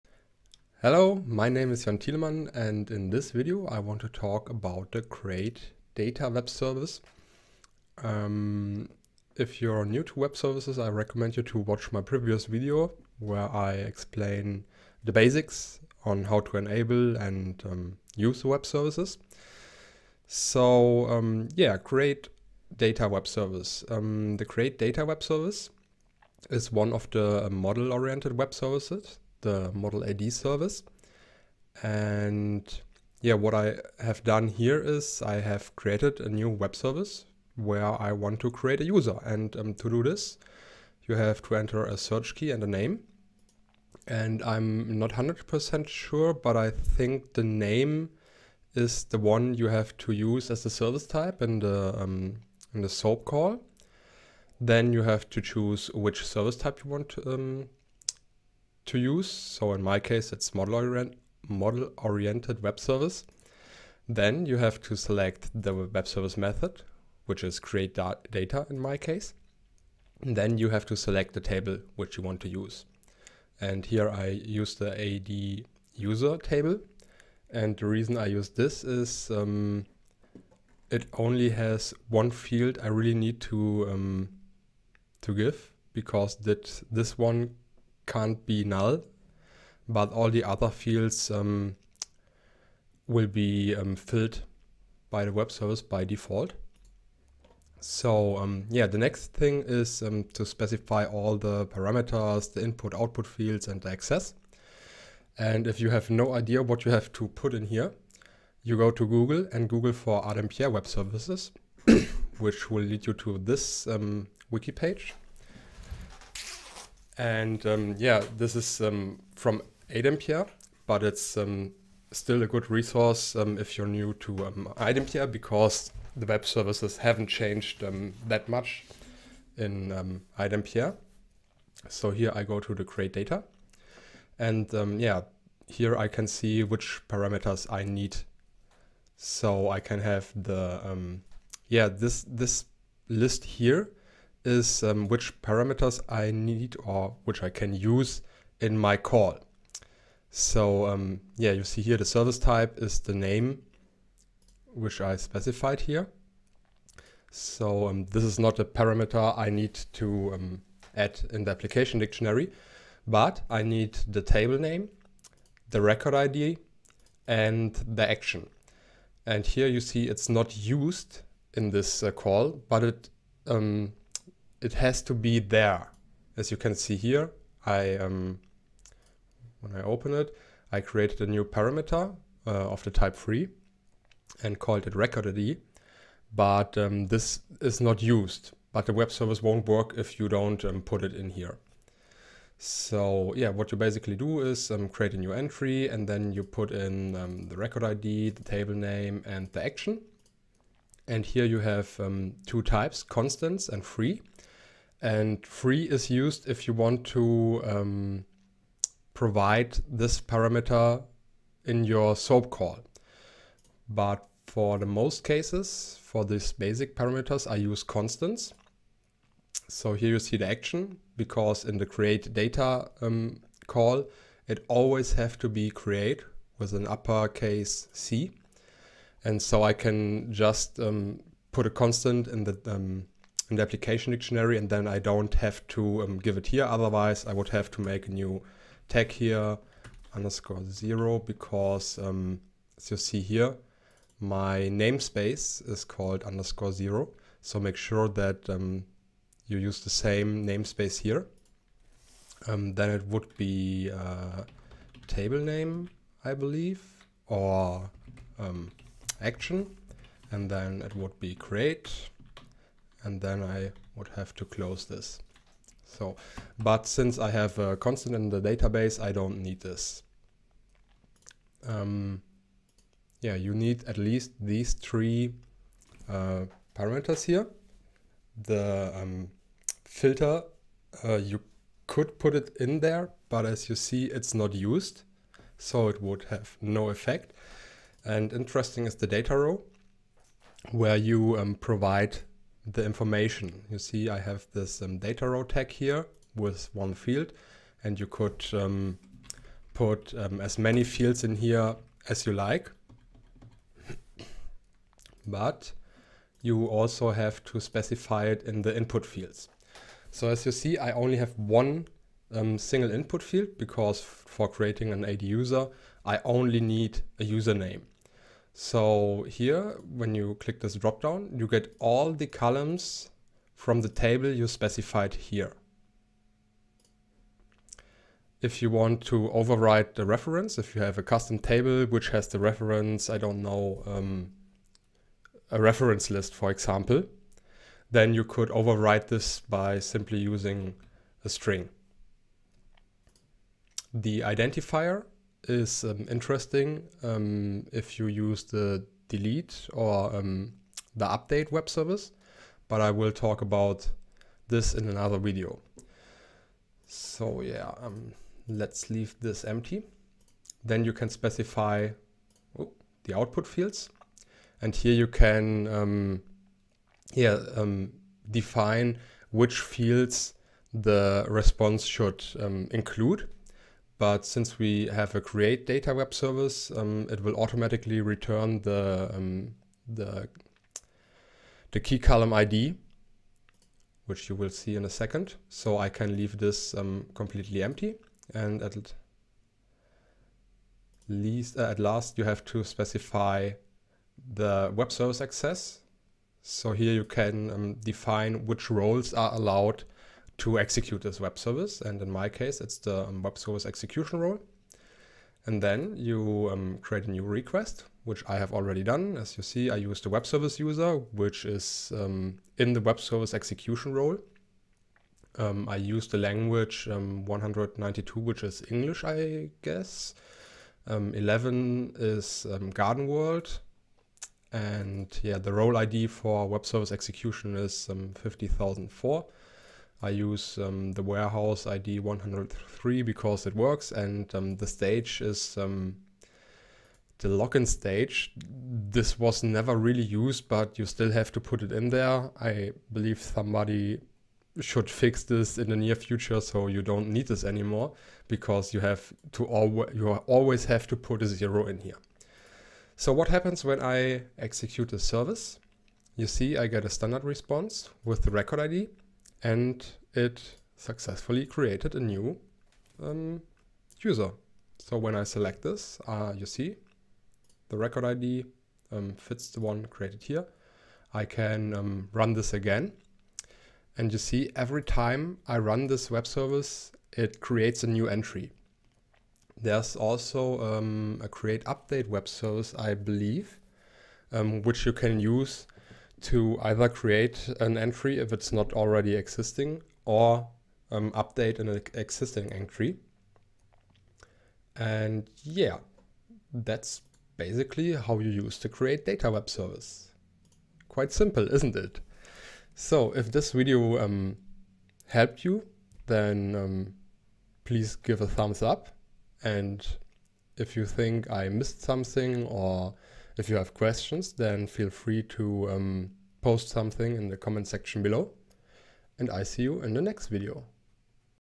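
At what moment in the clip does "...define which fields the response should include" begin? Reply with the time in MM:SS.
06:08.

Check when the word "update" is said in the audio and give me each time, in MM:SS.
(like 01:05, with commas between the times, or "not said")
05:51, 08:01, 08:11.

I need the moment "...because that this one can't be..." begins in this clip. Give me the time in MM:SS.
01:25.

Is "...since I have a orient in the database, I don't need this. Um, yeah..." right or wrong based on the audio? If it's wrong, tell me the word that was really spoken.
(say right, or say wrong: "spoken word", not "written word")
wrong: "constant", not "orient".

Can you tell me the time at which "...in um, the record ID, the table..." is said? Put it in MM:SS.
03:16.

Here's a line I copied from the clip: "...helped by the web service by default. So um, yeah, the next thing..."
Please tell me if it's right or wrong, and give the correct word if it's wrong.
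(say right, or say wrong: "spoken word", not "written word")
wrong: "filled", not "helped".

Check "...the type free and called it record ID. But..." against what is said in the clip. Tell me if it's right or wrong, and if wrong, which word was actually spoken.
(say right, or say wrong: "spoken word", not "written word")
right.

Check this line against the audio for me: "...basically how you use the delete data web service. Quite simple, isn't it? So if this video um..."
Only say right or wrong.
wrong.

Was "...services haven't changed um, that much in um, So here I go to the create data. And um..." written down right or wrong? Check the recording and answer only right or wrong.
right.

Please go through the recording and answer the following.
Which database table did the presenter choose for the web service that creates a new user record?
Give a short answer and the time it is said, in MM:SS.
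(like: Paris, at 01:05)
AD user table, at 01:14.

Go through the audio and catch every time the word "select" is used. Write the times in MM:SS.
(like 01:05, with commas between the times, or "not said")
01:04, 01:10, 07:45.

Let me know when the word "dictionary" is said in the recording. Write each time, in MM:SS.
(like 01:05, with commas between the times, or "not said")
02:41, 03:54.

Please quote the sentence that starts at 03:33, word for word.
But for the most cases, for these basic parameters, I use constants.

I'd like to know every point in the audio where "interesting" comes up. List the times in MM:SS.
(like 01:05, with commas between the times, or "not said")
04:48, 05:46.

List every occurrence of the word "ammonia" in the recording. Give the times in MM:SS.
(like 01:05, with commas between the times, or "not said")
not said.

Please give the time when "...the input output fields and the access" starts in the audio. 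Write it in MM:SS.
01:42.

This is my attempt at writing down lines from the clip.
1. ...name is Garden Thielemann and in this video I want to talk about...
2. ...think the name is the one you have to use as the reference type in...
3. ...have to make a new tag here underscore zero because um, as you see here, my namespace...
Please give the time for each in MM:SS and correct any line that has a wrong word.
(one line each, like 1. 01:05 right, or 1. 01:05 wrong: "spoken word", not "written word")
1. 00:01 wrong: "Jan", not "Garden"
2. 00:46 wrong: "service", not "reference"
3. 03:57 right.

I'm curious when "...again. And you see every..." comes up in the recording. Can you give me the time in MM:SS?
07:52.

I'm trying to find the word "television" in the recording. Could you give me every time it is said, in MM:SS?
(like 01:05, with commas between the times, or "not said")
not said.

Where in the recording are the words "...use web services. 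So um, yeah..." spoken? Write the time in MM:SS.
00:18.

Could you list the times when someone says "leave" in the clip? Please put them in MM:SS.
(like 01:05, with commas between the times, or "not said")
05:58, 06:26.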